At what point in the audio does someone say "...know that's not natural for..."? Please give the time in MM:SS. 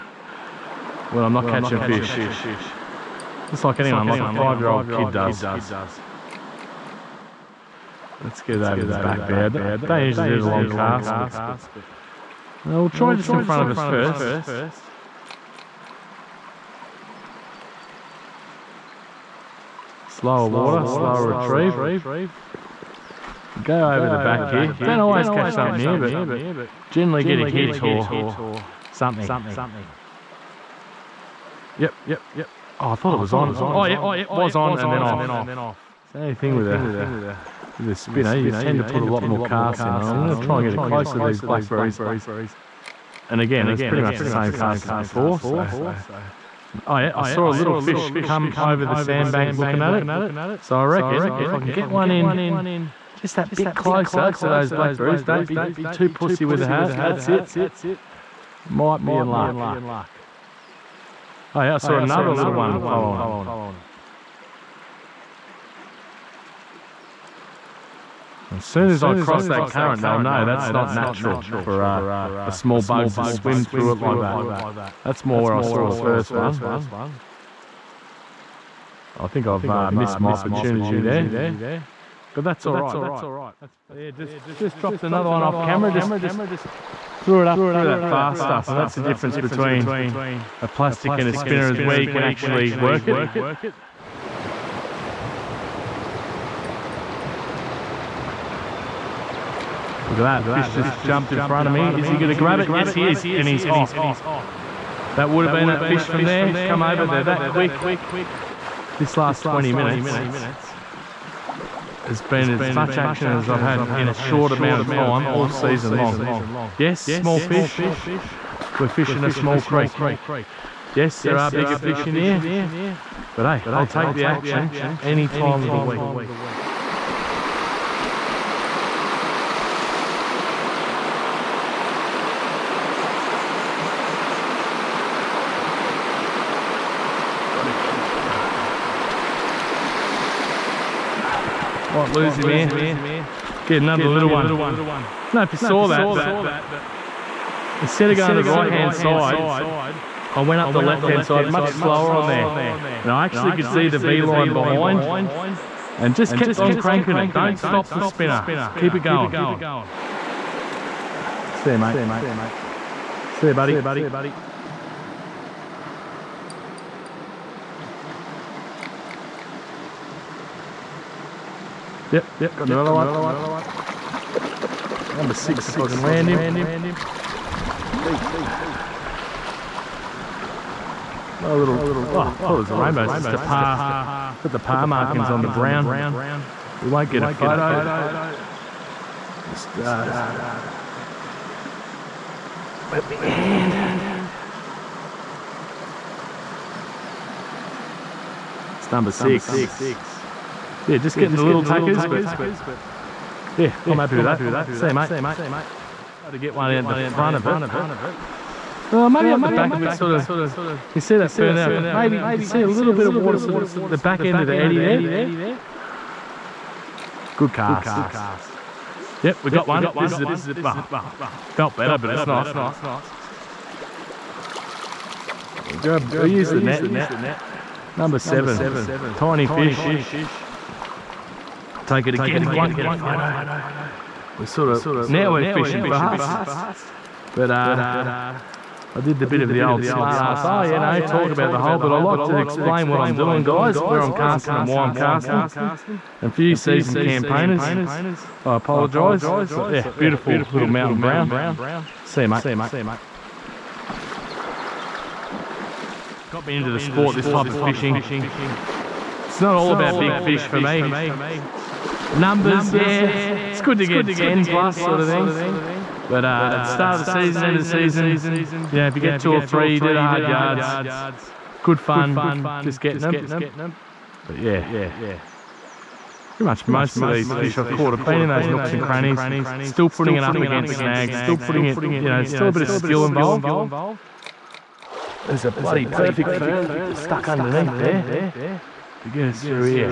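01:10.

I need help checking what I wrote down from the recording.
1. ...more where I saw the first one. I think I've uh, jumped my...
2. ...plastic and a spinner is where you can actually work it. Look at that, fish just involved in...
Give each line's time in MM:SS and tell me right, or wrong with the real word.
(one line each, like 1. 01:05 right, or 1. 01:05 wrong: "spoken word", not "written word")
1. 01:15 wrong: "missed", not "jumped"
2. 01:30 wrong: "jumped", not "involved".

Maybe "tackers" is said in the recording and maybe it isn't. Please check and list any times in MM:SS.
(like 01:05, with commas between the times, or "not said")
03:21.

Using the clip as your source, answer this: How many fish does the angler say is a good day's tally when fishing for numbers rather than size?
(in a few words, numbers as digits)
10 plus.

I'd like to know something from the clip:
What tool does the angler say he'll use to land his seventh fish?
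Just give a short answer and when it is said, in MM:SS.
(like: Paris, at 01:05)
The net, at 03:46.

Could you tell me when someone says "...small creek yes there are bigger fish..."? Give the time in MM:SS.
01:59.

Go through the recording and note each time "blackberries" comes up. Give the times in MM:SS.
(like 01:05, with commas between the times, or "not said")
00:41, 00:54.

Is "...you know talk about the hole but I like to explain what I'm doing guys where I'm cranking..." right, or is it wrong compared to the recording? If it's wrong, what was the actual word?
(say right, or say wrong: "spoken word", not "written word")
wrong: "casting", not "cranking".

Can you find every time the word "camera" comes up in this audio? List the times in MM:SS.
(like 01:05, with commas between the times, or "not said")
01:25.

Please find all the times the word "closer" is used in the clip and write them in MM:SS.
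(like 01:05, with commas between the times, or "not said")
00:40, 00:53.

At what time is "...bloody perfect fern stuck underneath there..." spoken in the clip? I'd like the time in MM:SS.
04:45.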